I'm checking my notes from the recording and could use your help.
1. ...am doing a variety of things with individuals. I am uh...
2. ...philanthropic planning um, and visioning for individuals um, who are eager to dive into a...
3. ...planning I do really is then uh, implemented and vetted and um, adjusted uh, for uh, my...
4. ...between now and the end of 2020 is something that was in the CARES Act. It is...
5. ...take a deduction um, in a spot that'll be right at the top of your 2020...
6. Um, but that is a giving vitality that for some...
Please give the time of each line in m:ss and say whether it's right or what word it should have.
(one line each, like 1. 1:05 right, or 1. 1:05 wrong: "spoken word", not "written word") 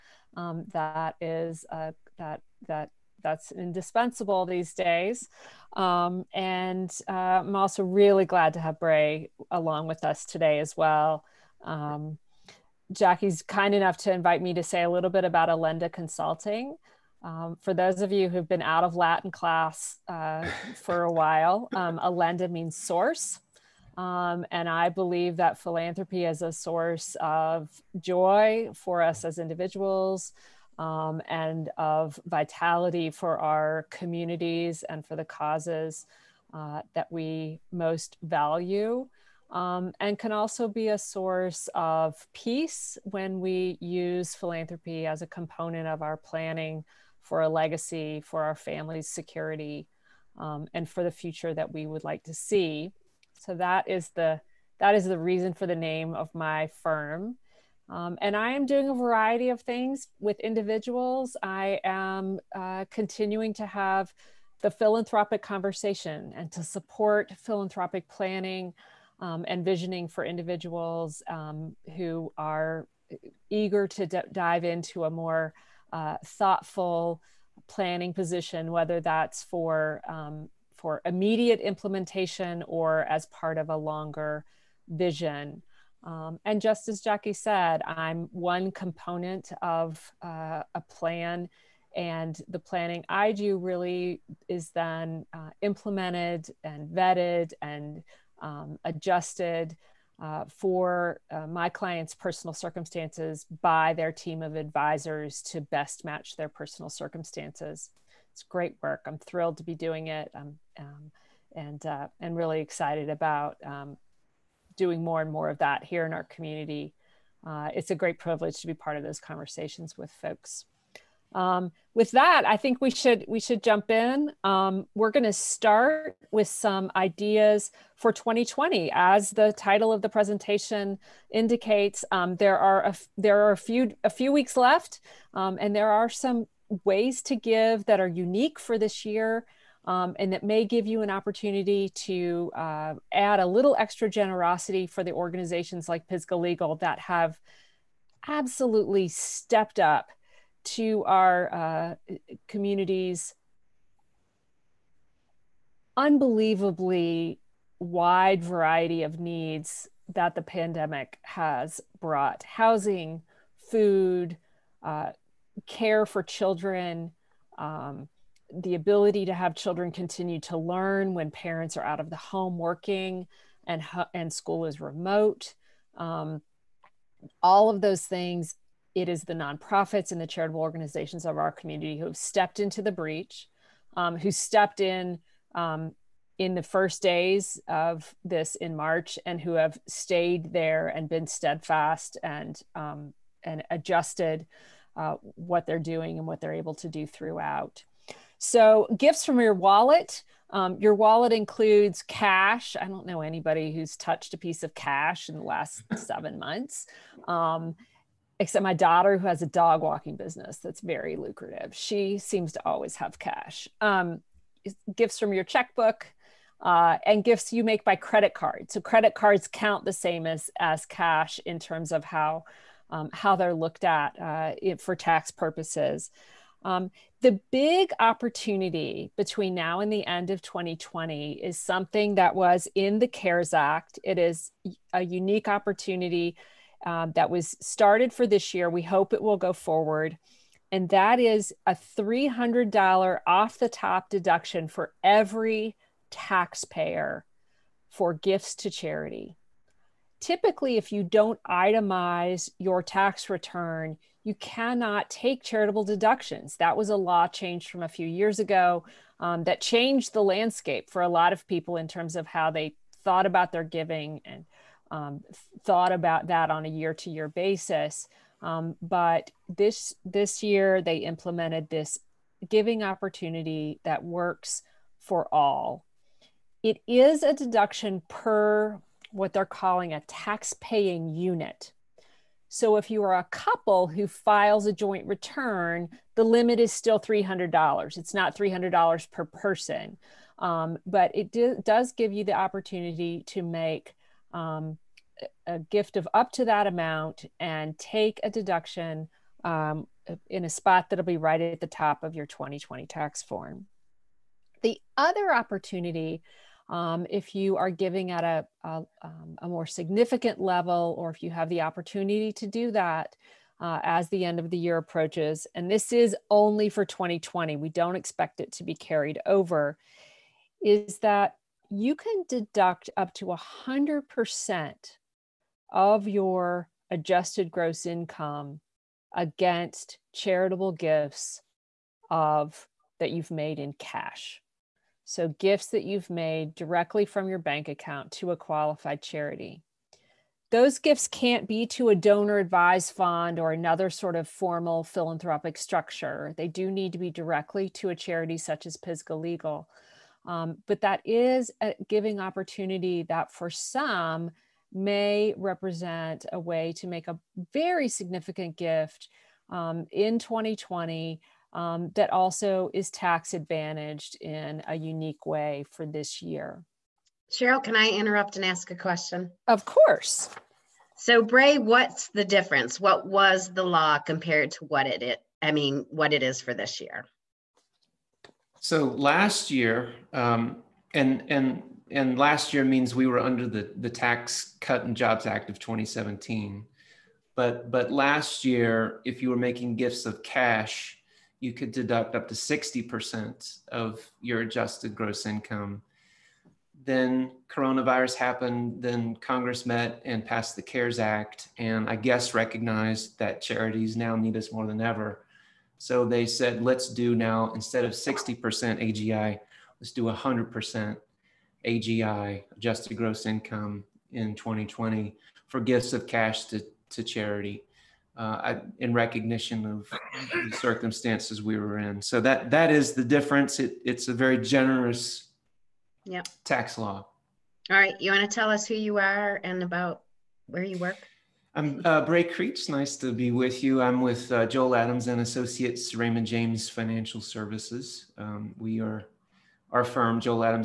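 1. 0:58 right
2. 1:07 right
3. 1:32 right
4. 3:49 right
5. 4:57 right
6. 5:50 wrong: "opportunity", not "vitality".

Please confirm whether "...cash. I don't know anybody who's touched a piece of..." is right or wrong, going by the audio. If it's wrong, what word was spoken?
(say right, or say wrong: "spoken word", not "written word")
right.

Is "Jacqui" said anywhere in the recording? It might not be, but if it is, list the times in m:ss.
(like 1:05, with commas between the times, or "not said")
0:12, 1:27.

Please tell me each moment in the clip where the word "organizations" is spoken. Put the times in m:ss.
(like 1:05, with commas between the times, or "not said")
2:25, 3:00.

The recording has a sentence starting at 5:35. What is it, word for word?
So, gifts that you've made directly from your bank account to a qualified charity.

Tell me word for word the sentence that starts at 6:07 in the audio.
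Sheryl, can I interrupt and ask a question?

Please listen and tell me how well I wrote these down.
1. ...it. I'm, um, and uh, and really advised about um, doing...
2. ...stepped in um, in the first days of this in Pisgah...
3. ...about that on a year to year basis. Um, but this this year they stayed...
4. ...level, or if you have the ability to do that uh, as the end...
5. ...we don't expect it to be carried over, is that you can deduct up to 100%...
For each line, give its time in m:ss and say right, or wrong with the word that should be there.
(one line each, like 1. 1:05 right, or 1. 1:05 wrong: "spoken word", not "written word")
1. 1:50 wrong: "excited", not "advised"
2. 3:04 wrong: "March", not "Pisgah"
3. 4:25 wrong: "implemented", not "stayed"
4. 5:10 wrong: "opportunity", not "ability"
5. 5:17 right.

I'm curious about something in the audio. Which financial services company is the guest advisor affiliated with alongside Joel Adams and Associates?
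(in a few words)
Raymond James Financial Services.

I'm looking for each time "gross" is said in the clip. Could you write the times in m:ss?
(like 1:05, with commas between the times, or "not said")
5:27, 6:34, 6:52.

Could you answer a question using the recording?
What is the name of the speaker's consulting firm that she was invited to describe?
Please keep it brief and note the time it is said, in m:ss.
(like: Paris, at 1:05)
Alenda Consulting, at 0:15.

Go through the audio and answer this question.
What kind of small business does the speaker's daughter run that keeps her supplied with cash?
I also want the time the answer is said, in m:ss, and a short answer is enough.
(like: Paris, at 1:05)
Dog walking business, at 3:29.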